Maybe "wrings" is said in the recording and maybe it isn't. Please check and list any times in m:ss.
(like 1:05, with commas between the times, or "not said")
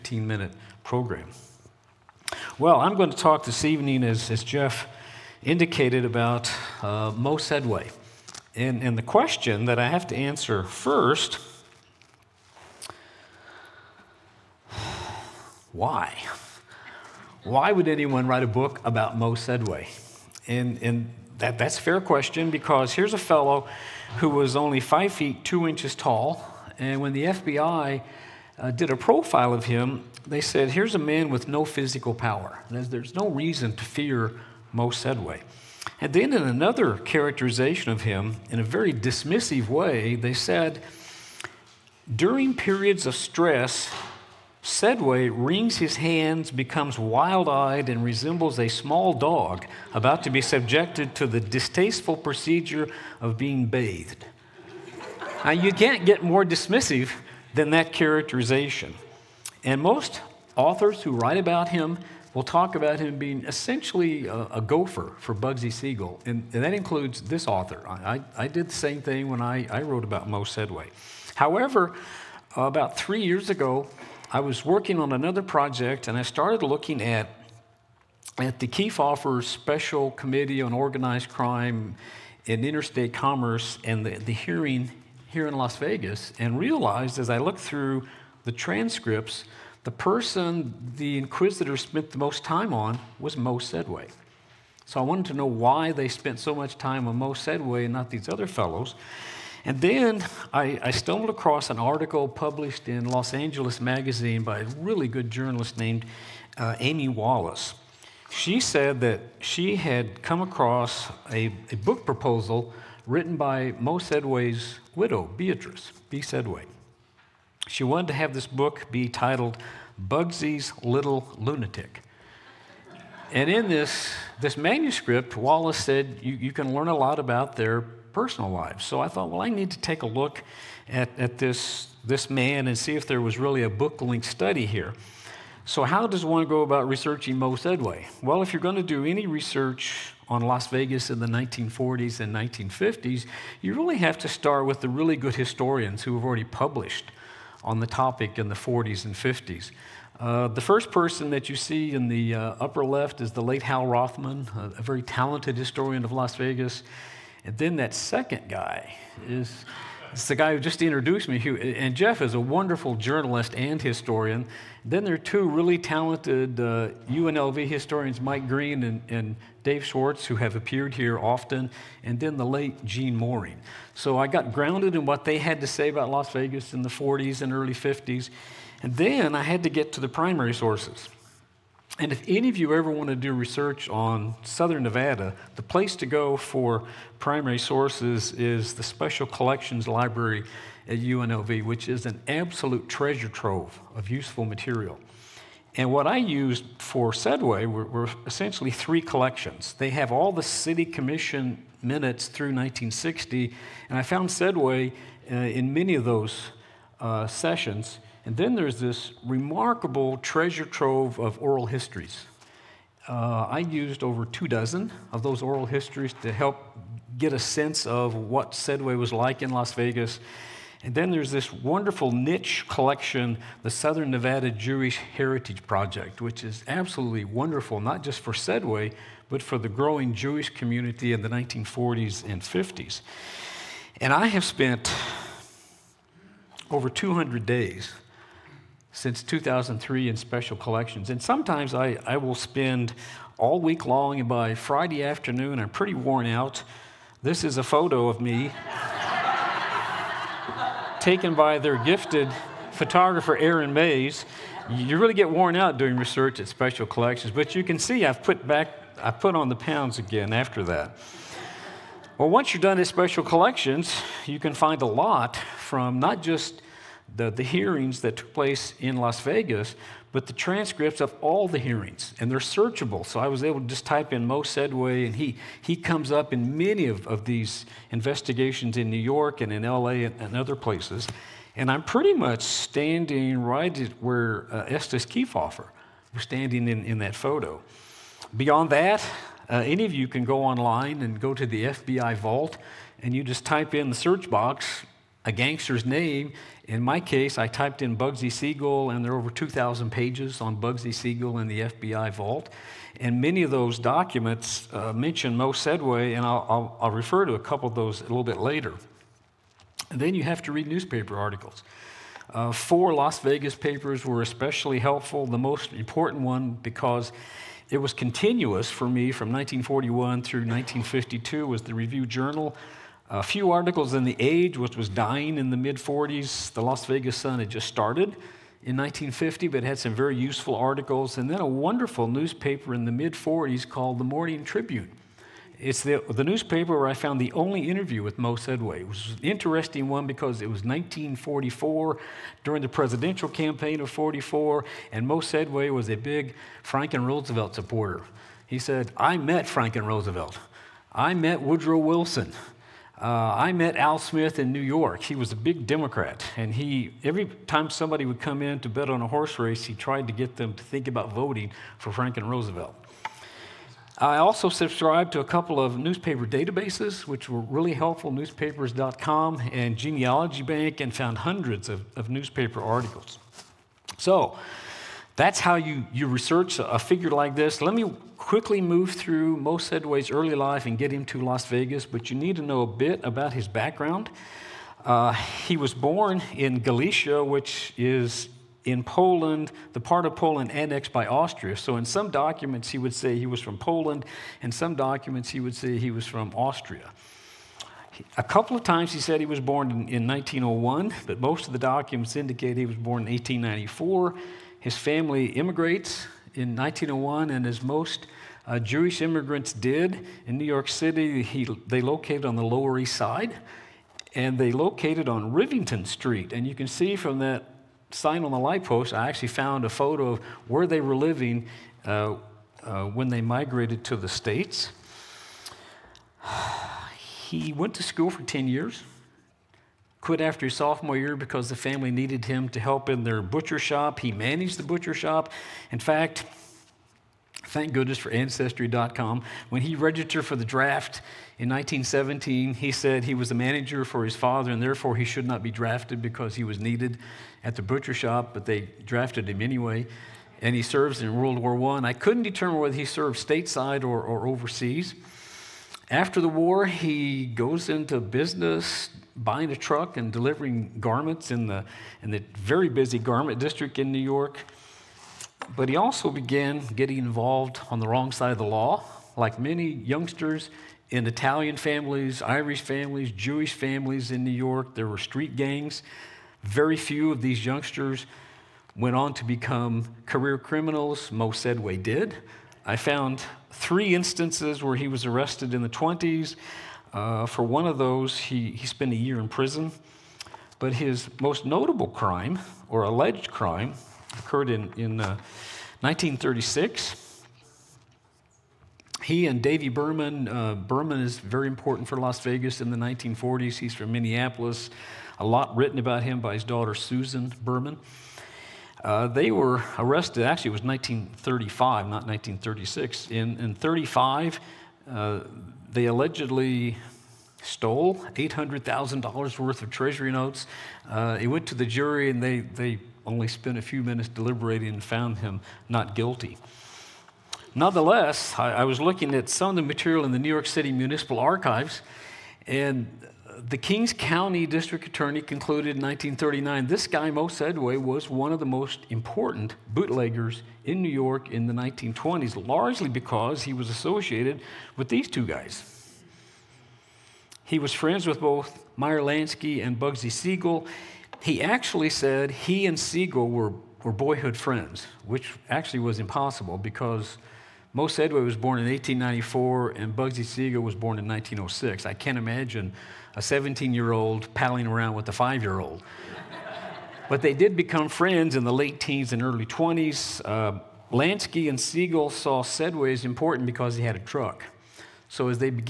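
0:45.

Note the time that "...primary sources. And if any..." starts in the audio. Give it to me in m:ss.
3:00.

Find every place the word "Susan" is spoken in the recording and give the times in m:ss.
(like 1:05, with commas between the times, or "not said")
8:26.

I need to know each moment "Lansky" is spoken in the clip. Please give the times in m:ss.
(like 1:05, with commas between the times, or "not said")
9:08, 9:30.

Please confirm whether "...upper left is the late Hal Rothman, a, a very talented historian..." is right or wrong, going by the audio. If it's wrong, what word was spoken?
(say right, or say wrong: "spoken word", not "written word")
right.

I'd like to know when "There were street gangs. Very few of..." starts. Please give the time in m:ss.
7:54.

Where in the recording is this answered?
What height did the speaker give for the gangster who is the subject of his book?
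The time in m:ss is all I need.
0:24.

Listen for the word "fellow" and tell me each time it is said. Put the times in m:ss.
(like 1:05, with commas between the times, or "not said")
0:23, 1:38.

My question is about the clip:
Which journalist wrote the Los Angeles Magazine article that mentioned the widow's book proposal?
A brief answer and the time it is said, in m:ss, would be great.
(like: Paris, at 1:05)
Amy Wallace, at 1:46.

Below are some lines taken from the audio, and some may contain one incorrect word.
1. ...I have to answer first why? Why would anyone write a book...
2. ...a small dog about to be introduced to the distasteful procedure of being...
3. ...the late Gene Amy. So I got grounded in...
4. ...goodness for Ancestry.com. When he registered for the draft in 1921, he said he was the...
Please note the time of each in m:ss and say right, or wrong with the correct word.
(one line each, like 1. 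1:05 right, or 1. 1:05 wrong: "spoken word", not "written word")
1. 0:09 right
2. 0:48 wrong: "subjected", not "introduced"
3. 2:52 wrong: "Moehring", not "Amy"
4. 7:17 wrong: "1917", not "1921".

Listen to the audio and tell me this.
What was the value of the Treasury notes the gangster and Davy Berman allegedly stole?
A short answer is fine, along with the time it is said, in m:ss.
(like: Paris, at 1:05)
$800,000, at 8:38.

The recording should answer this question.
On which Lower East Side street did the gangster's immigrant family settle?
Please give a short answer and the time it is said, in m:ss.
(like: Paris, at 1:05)
Rivington Street, at 6:55.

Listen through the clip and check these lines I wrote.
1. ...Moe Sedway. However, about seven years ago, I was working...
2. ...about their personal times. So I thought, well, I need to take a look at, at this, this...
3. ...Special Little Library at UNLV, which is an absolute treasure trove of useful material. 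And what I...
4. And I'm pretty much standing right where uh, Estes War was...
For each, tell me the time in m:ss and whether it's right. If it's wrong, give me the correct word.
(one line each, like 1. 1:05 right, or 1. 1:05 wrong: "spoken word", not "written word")
1. 1:10 wrong: "three", not "seven"
2. 2:07 wrong: "lives", not "times"
3. 3:08 wrong: "Collections", not "Little"
4. 4:41 wrong: "Kefauver", not "War".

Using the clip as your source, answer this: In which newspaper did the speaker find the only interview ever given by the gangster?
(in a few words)
The Morning Tribune.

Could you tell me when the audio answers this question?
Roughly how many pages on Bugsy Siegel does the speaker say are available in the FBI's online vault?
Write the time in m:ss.
4:59.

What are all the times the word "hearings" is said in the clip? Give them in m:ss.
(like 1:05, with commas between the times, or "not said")
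1:24, 4:27, 4:31.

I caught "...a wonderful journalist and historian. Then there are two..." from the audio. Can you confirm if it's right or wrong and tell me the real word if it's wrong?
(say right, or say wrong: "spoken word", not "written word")
right.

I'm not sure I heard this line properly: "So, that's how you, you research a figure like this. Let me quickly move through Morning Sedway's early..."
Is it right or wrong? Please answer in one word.
wrong.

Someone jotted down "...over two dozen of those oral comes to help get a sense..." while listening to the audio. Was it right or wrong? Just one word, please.
wrong.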